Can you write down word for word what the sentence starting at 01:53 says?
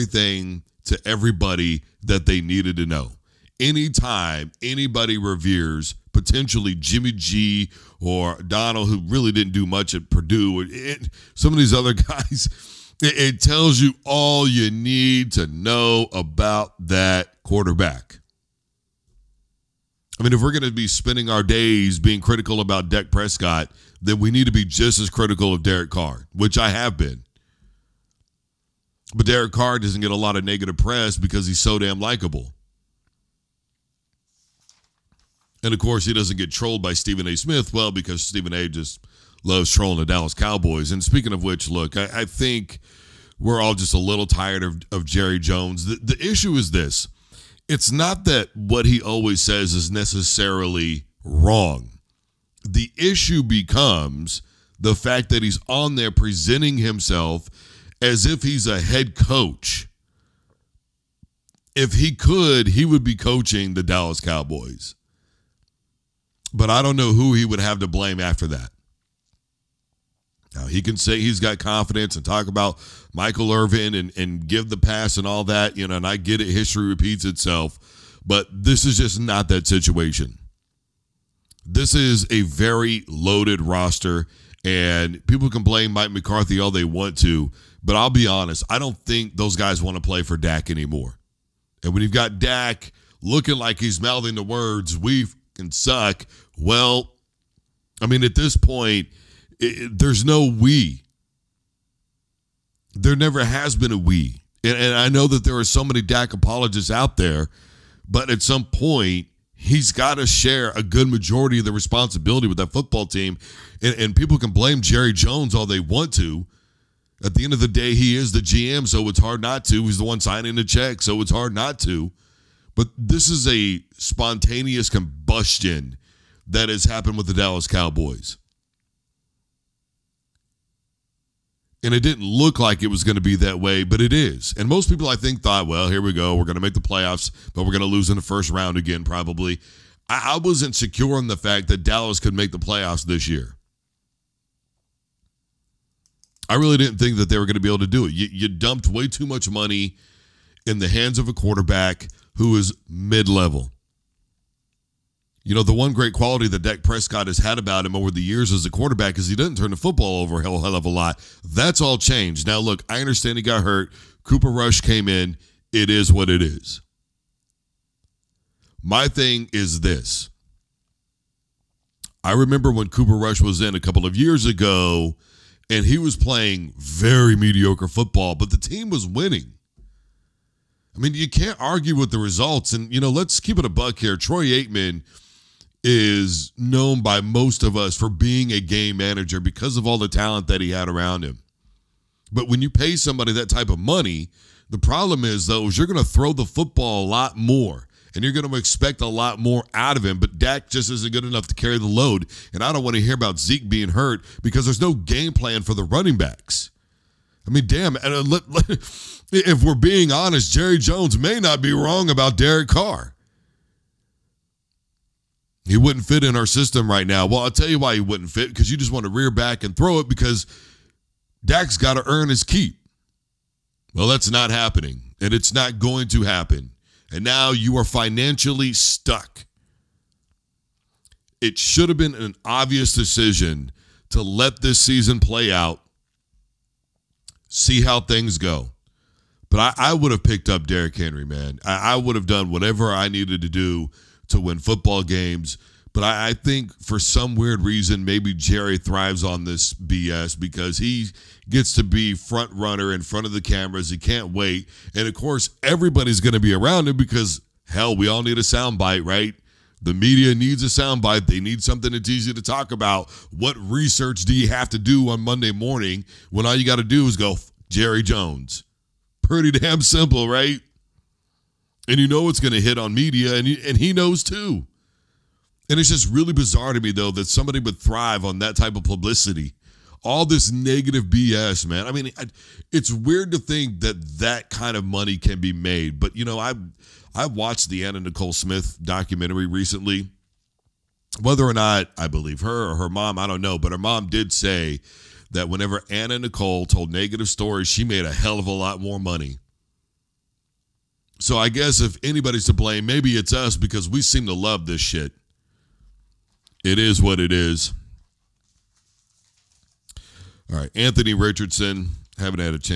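And, and, people can blame Jerry Jones all they want to.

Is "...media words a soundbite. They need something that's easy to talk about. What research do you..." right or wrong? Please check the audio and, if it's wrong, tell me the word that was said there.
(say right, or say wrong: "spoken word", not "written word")
wrong: "needs", not "words".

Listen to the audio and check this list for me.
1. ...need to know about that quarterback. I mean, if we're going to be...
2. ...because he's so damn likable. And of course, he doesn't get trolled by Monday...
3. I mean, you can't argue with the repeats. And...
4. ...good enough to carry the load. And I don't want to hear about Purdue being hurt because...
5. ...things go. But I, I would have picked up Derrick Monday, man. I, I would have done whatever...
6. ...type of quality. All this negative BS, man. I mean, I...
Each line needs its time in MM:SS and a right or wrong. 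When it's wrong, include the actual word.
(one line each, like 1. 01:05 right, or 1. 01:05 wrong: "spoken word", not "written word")
1. 00:14 right
2. 00:31 wrong: "Stephen", not "Monday"
3. 03:00 wrong: "results", not "repeats"
4. 03:21 wrong: "Zeke", not "Purdue"
5. 03:57 wrong: "Henry", not "Monday"
6. 04:38 wrong: "publicity", not "quality".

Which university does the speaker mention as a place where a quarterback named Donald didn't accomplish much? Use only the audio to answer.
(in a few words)
Purdue.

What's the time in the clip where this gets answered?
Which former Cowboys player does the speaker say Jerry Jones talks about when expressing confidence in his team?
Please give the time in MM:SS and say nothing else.
01:13.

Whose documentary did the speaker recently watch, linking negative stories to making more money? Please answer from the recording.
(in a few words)
Anna Nicole Smith.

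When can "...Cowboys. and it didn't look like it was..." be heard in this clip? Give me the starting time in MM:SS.
02:07.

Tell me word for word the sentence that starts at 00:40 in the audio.
And speaking of which, look, I, I think we're all just a little tired of, of Jerry Jones.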